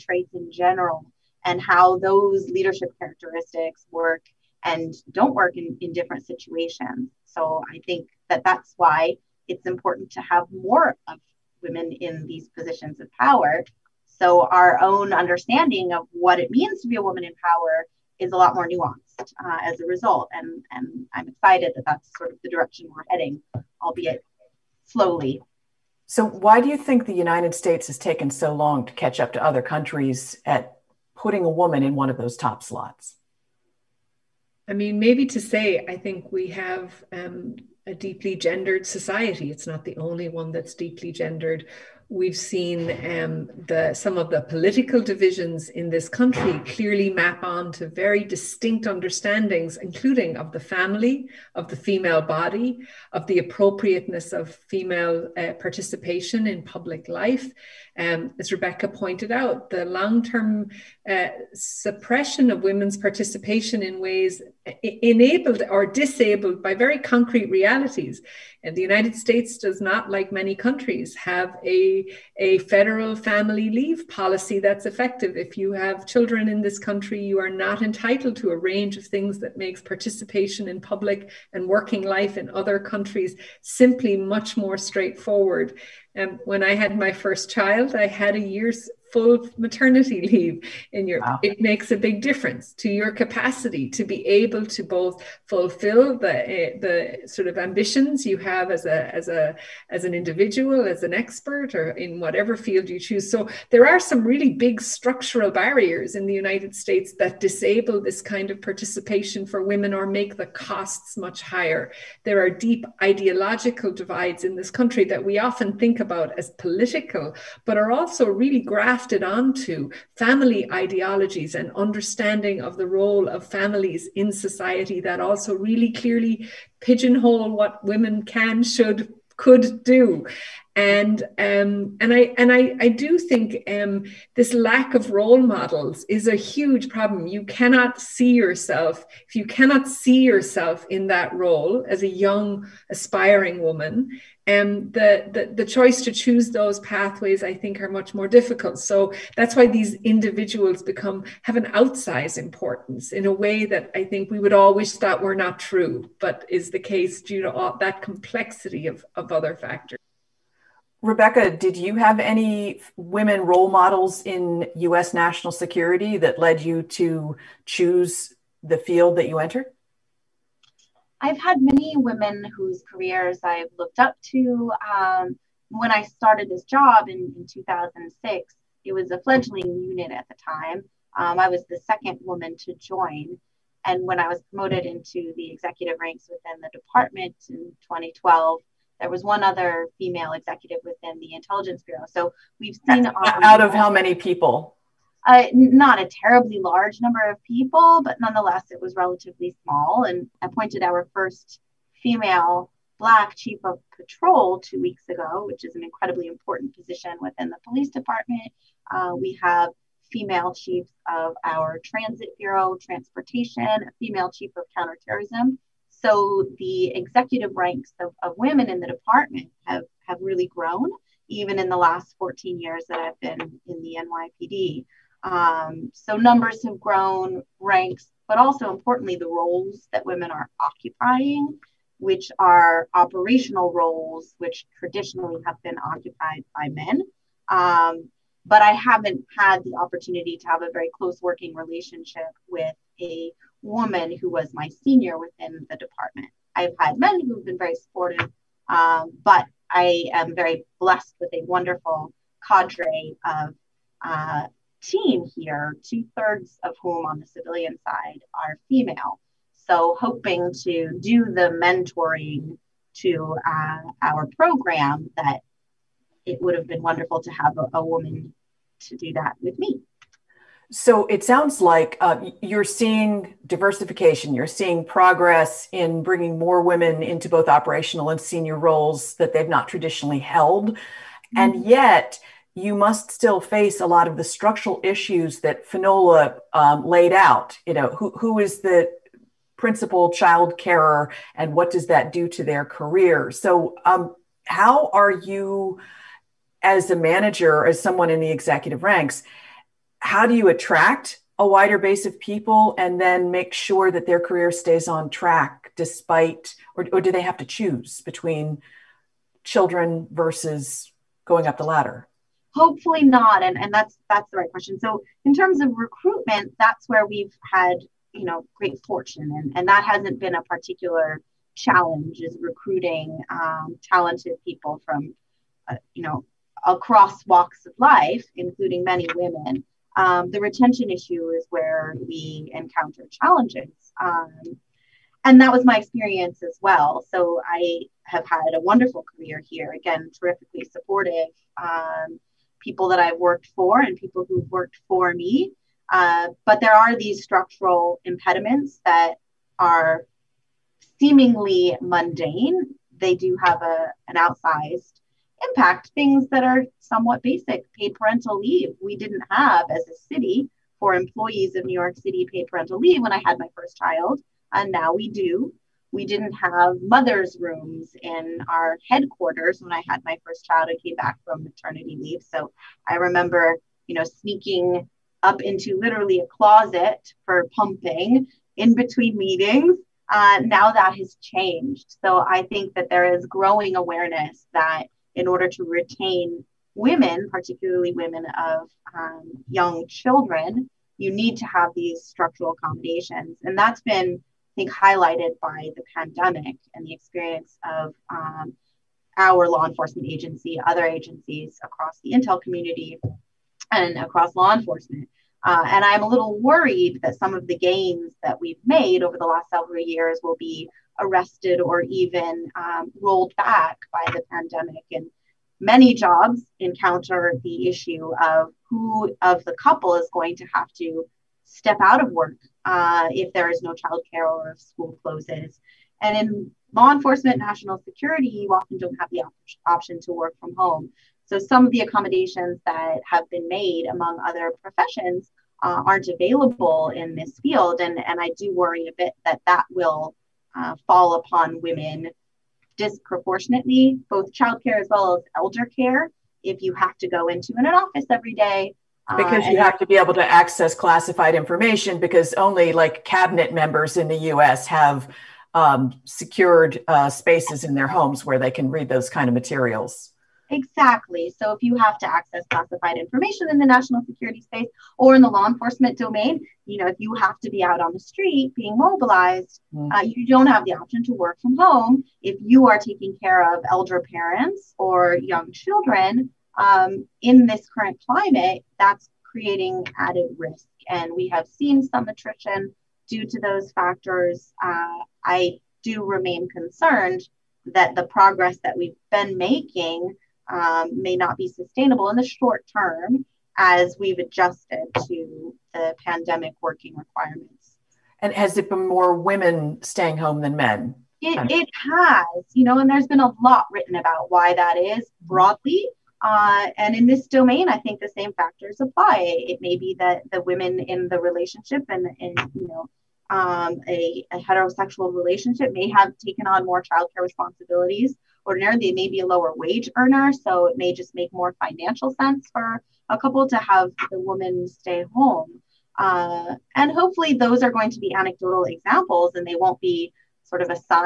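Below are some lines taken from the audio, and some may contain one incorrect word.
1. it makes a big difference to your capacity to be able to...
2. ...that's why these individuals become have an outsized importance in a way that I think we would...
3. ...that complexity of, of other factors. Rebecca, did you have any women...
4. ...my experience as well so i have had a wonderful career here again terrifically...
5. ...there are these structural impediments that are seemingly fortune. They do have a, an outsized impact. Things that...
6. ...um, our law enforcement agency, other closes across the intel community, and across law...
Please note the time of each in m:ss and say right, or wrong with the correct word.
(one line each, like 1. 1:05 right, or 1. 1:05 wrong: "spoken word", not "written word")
1. 1:31 right
2. 2:29 right
3. 2:37 right
4. 5:35 right
5. 5:46 wrong: "mundane", not "fortune"
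6. 6:38 wrong: "agencies", not "closes".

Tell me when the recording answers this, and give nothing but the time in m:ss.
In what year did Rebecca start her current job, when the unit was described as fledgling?
2:57.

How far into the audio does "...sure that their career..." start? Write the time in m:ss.
5:03.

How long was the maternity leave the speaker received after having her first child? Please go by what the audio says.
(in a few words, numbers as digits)
A year.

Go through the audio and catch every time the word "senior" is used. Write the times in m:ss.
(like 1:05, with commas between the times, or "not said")
4:04, 4:38.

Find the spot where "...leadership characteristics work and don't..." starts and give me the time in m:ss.
0:02.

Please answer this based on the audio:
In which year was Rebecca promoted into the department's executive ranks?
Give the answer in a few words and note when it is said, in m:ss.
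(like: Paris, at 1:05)
2012, at 3:07.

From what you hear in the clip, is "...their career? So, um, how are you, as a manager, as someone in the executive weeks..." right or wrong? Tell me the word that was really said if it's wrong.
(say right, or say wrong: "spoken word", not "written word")
wrong: "ranks", not "weeks".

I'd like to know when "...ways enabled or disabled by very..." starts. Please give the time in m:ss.
1:03.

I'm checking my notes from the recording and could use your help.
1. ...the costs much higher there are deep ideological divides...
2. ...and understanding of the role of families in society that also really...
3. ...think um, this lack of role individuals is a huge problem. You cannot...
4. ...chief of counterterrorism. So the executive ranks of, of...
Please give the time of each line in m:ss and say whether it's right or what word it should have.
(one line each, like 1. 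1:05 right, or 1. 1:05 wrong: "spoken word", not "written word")
1. 1:50 right
2. 2:01 right
3. 2:13 wrong: "models", not "individuals"
4. 3:34 right.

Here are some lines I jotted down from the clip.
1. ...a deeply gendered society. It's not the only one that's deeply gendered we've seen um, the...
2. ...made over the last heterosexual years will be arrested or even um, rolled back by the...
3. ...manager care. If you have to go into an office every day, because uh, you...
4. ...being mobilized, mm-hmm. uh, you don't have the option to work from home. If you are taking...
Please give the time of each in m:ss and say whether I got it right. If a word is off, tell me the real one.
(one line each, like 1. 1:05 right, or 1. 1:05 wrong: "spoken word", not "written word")
1. 0:37 right
2. 6:48 wrong: "several", not "heterosexual"
3. 7:25 wrong: "elder", not "manager"
4. 7:48 right.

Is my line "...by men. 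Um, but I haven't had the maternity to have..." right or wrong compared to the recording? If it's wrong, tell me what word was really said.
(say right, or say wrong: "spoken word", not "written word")
wrong: "opportunity", not "maternity".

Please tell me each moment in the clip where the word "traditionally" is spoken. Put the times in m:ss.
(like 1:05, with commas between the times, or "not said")
3:54, 4:39.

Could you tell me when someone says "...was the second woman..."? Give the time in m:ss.
3:01.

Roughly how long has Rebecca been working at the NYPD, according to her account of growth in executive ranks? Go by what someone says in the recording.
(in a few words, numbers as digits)
14 years.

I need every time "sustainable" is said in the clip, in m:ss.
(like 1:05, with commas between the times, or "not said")
8:11.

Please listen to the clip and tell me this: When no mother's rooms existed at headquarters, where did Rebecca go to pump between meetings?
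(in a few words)
A closet.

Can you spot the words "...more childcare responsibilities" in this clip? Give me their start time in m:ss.
8:36.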